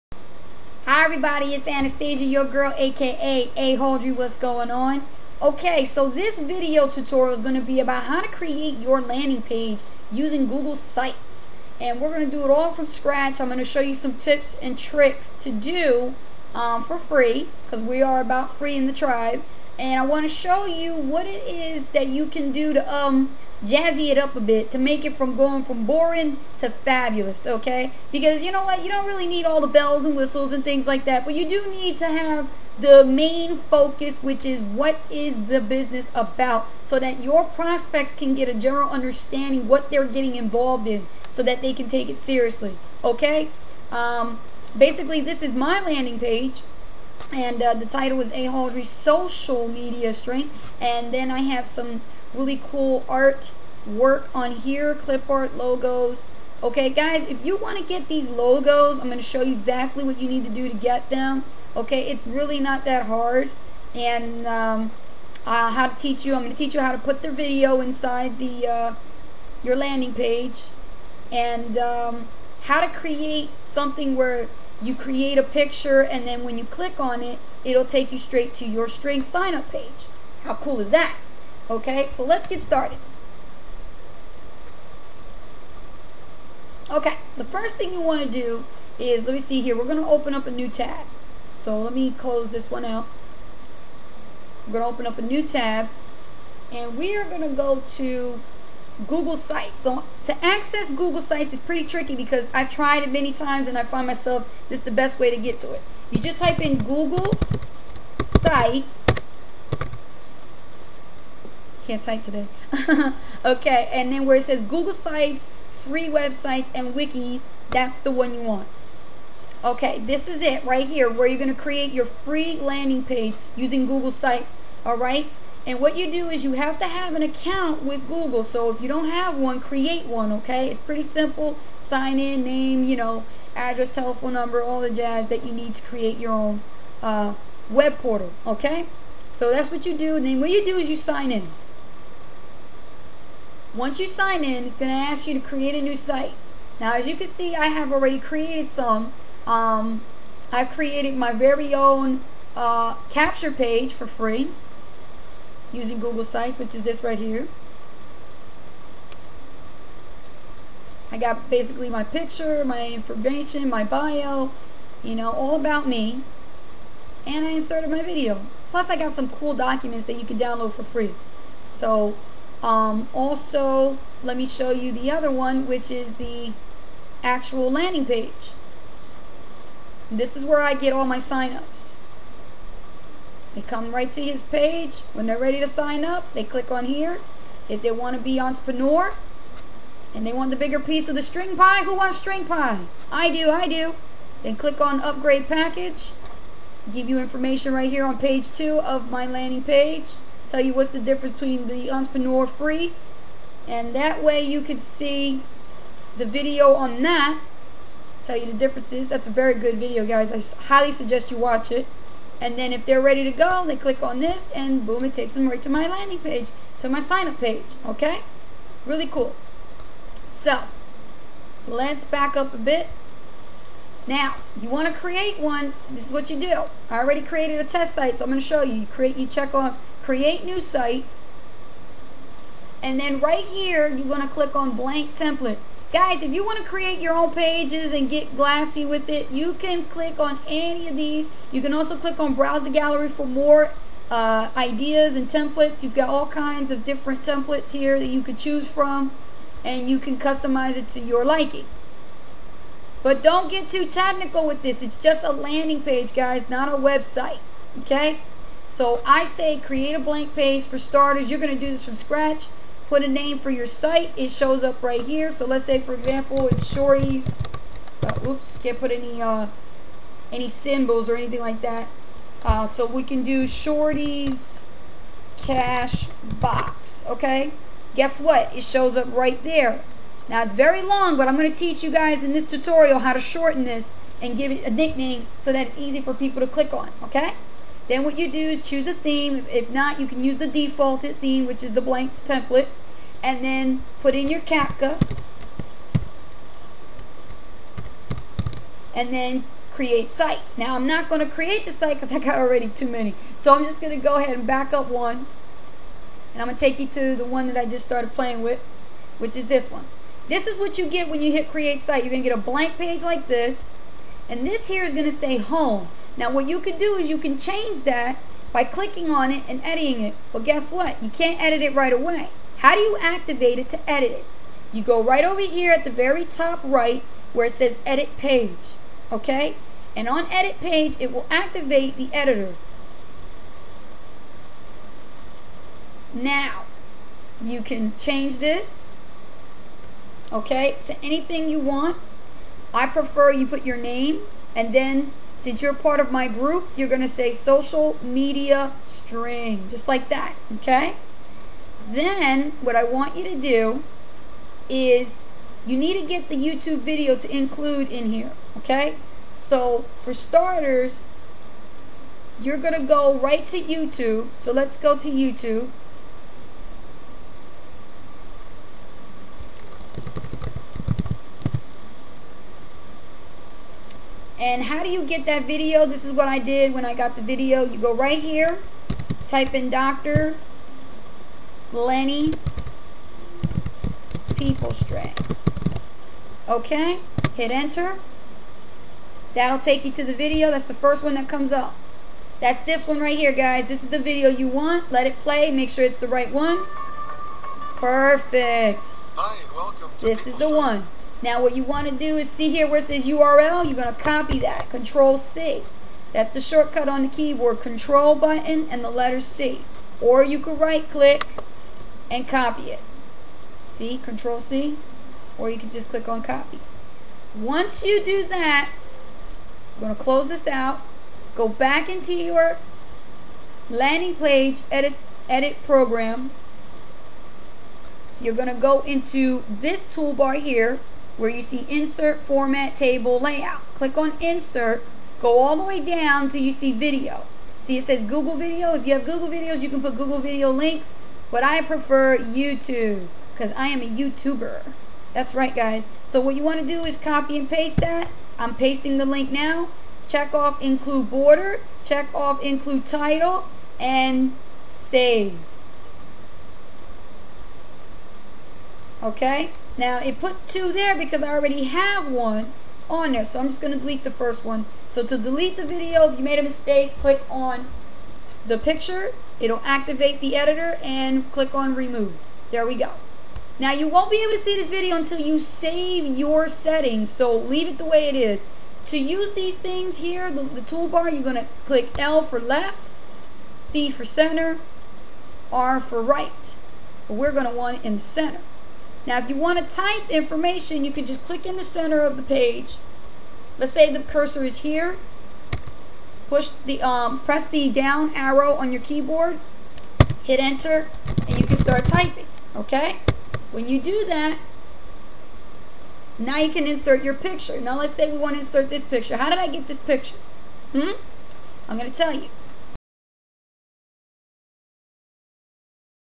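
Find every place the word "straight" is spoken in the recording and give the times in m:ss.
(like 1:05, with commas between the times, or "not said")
1:18.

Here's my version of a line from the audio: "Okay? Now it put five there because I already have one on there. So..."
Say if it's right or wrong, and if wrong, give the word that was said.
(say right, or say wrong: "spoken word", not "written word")
wrong: "two", not "five".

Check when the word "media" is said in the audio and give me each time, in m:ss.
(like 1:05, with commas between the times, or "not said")
0:49, 5:48.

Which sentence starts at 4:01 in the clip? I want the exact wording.
You can also click on browse the gallery for more uh, ideas and templates.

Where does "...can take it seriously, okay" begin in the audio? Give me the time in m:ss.
0:41.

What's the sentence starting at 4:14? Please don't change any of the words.
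It's just a landing page, guys, not a website.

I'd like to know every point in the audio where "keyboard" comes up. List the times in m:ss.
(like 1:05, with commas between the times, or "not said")
6:47, 8:18.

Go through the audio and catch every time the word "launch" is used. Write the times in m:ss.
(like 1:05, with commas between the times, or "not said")
not said.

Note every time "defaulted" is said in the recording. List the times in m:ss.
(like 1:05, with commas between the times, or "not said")
4:50.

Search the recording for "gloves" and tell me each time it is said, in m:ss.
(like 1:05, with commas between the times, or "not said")
not said.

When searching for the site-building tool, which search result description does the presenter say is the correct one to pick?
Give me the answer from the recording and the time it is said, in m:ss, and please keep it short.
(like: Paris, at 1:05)
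free websites, and wikis, at 1:55.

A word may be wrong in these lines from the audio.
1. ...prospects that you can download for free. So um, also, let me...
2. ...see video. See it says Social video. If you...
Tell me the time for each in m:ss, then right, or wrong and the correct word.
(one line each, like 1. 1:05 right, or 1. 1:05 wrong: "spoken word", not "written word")
1. 2:49 wrong: "documents", not "prospects"
2. 7:16 wrong: "Google", not "Social".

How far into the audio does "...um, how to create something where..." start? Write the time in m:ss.
1:11.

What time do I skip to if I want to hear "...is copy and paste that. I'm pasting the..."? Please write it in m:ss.
7:26.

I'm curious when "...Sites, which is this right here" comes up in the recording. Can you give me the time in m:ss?
2:36.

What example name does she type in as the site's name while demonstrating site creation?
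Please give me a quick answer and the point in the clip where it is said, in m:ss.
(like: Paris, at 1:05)
Shorty's Cash Box, at 4:33.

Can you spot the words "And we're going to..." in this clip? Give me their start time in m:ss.
0:11.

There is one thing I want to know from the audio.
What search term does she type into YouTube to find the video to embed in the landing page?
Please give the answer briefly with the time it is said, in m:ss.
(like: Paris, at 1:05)
Dr. Lenny PeopleString, at 6:19.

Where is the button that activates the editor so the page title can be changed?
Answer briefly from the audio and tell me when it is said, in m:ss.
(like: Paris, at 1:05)
very top right, at 5:25.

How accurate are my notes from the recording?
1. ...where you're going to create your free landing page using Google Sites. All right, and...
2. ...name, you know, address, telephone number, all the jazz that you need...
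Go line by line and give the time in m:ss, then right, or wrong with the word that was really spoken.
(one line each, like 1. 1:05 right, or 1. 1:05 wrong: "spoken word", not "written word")
1. 2:01 right
2. 2:12 right.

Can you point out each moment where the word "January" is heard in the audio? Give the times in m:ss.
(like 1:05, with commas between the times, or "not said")
not said.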